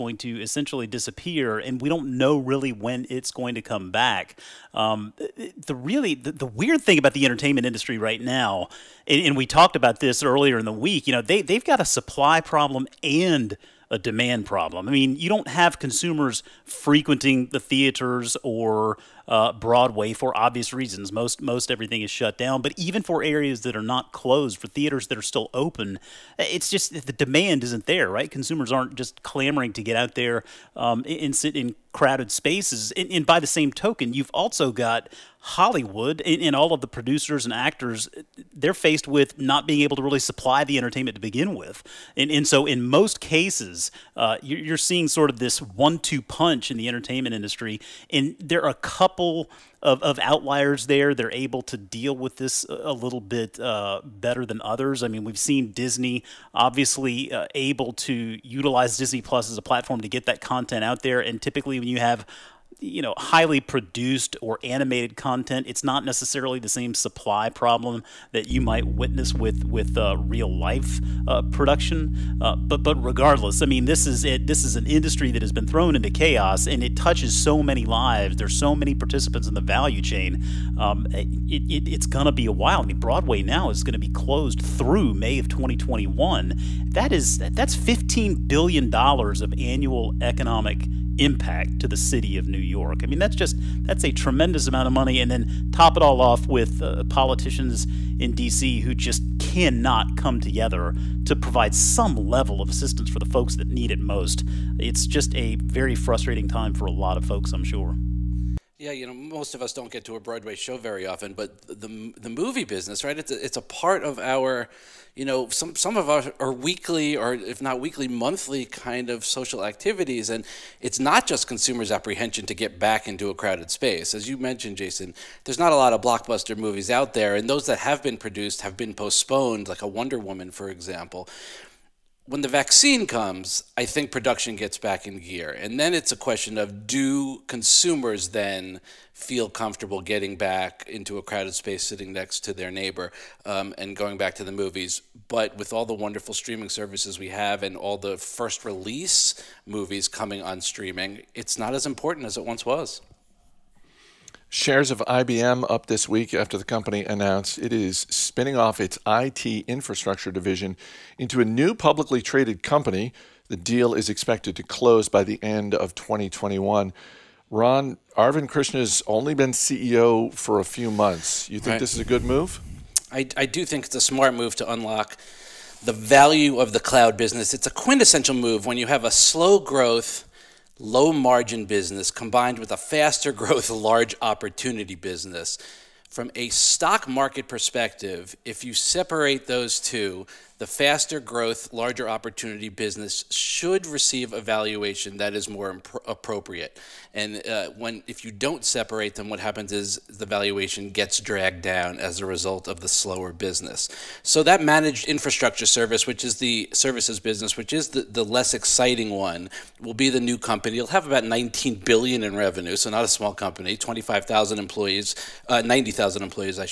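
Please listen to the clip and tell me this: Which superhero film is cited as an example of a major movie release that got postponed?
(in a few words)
Wonder Woman.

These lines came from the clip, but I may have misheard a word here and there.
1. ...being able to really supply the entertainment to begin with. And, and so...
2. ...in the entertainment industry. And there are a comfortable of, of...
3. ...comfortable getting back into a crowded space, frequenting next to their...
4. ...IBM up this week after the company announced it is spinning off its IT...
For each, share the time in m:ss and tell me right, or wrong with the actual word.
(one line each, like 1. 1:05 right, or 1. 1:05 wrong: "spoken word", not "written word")
1. 0:39 right
2. 0:46 wrong: "couple", not "comfortable"
3. 2:19 wrong: "sitting", not "frequenting"
4. 2:35 right.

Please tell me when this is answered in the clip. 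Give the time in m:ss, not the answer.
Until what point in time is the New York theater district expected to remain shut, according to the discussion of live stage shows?
1:25.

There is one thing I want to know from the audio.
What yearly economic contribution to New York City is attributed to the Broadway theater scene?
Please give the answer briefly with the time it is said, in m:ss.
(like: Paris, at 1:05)
$15 billion, at 1:27.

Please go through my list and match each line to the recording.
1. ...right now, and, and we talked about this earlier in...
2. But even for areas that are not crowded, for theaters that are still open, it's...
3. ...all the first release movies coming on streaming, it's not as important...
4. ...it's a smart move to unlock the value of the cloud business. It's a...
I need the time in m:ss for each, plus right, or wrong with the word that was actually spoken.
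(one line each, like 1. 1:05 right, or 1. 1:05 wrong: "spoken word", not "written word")
1. 0:07 right
2. 0:22 wrong: "closed", not "crowded"
3. 2:27 right
4. 2:53 right.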